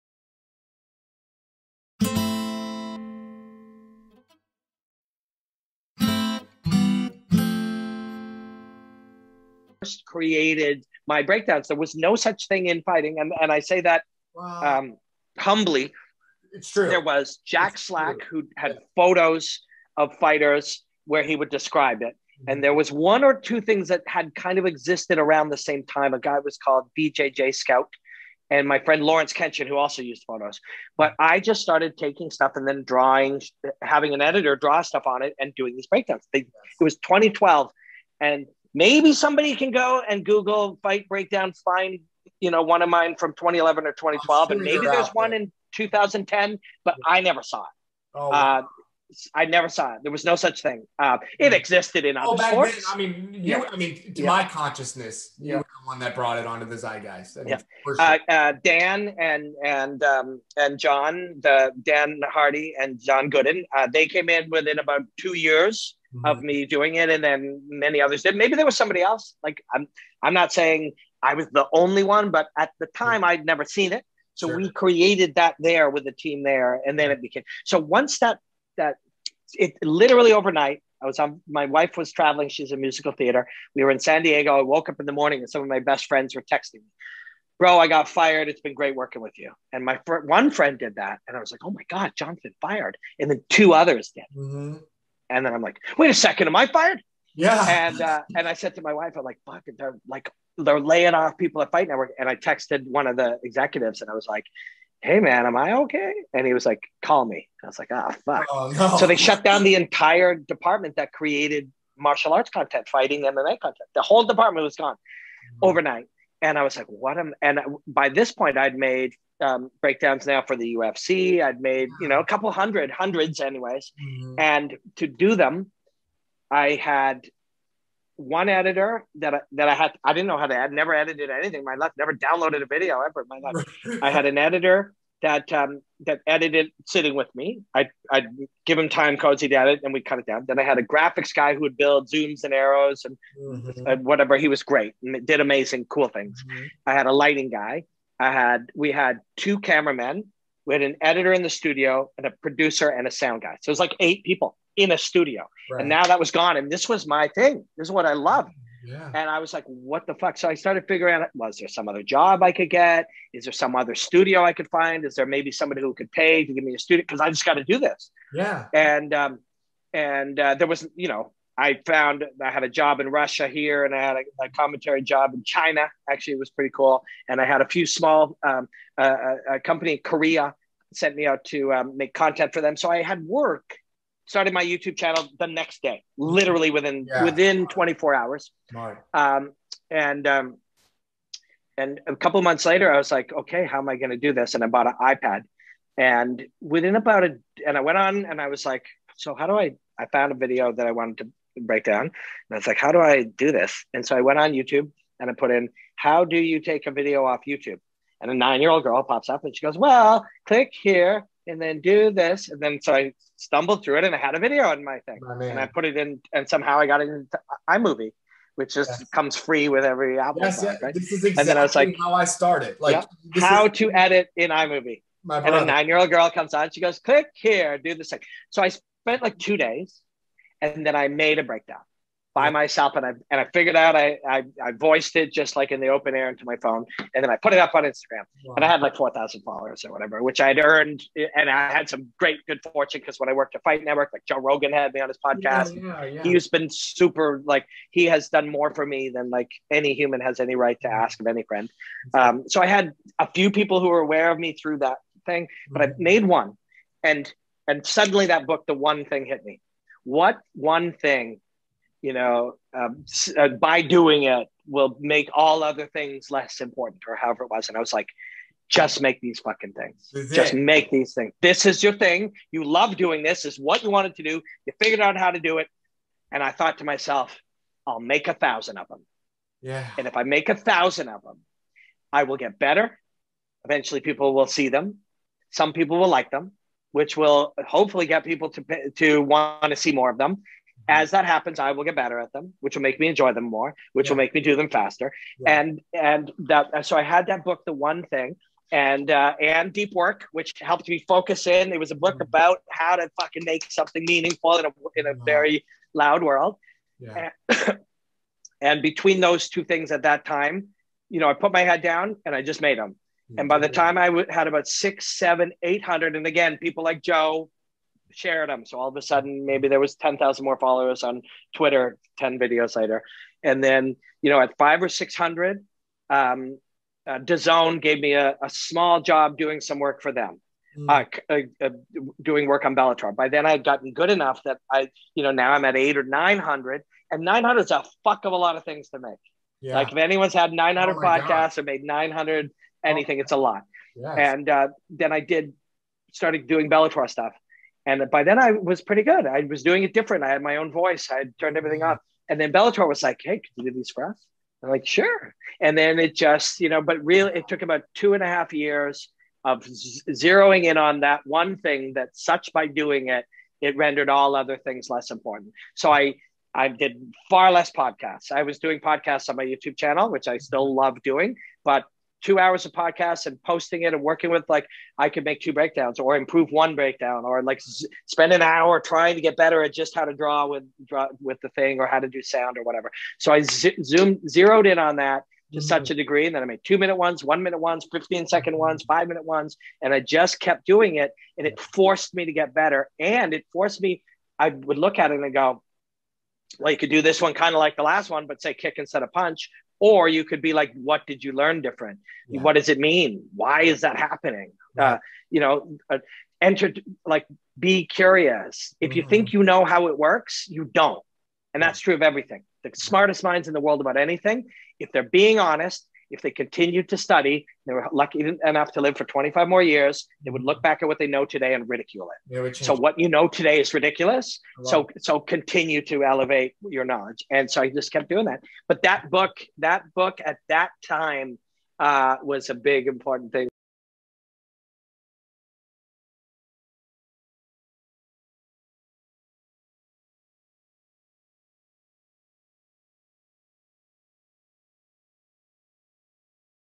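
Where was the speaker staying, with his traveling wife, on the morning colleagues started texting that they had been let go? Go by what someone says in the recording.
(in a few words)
San Diego.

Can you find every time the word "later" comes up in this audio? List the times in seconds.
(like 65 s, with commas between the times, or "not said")
192 s, 322 s.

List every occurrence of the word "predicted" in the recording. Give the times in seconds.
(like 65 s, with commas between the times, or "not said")
not said.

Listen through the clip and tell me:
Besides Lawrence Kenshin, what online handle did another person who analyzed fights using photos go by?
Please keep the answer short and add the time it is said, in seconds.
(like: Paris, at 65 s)
BJJ Scout, at 26 s.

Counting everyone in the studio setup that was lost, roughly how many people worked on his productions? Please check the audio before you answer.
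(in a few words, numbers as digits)
8.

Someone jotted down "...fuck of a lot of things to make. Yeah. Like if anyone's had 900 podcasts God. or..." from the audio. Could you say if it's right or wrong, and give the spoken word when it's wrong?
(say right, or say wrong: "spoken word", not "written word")
right.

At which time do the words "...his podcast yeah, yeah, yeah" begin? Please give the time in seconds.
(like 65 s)
245 s.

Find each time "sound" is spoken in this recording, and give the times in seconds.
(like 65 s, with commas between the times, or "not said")
153 s, 382 s.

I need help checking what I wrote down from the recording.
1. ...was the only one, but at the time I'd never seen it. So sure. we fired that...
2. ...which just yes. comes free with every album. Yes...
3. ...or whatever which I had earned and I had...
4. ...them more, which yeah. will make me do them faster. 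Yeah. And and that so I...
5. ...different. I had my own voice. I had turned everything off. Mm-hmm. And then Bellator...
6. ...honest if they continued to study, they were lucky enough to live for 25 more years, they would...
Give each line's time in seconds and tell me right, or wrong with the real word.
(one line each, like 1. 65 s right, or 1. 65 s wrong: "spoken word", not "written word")
1. 71 s wrong: "created", not "fired"
2. 218 s right
3. 239 s right
4. 293 s right
5. 349 s right
6. 415 s right.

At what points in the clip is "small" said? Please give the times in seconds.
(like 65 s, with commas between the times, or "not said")
177 s, 328 s.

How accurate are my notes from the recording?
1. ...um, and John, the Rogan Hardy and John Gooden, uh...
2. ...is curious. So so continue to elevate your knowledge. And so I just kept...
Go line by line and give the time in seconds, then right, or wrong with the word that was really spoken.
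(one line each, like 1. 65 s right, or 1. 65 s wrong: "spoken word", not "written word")
1. 60 s wrong: "Dan", not "Rogan"
2. 423 s wrong: "ridiculous", not "curious".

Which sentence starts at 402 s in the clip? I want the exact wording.
what does it mean why is that happening uh, you know uh, enter like be curious if mm-hmm.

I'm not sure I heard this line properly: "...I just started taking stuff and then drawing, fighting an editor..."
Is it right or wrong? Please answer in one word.
wrong.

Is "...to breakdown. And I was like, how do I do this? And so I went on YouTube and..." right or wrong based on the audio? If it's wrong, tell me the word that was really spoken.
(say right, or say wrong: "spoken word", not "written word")
right.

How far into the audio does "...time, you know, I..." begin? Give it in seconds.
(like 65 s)
310 s.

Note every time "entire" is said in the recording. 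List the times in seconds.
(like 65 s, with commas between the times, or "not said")
109 s.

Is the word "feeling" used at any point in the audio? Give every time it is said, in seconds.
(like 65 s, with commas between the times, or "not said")
not said.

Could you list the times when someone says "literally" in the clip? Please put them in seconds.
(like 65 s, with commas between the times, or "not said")
79 s, 186 s.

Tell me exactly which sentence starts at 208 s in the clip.
And a nine year old girl pops up and she goes, well, click here and then do this.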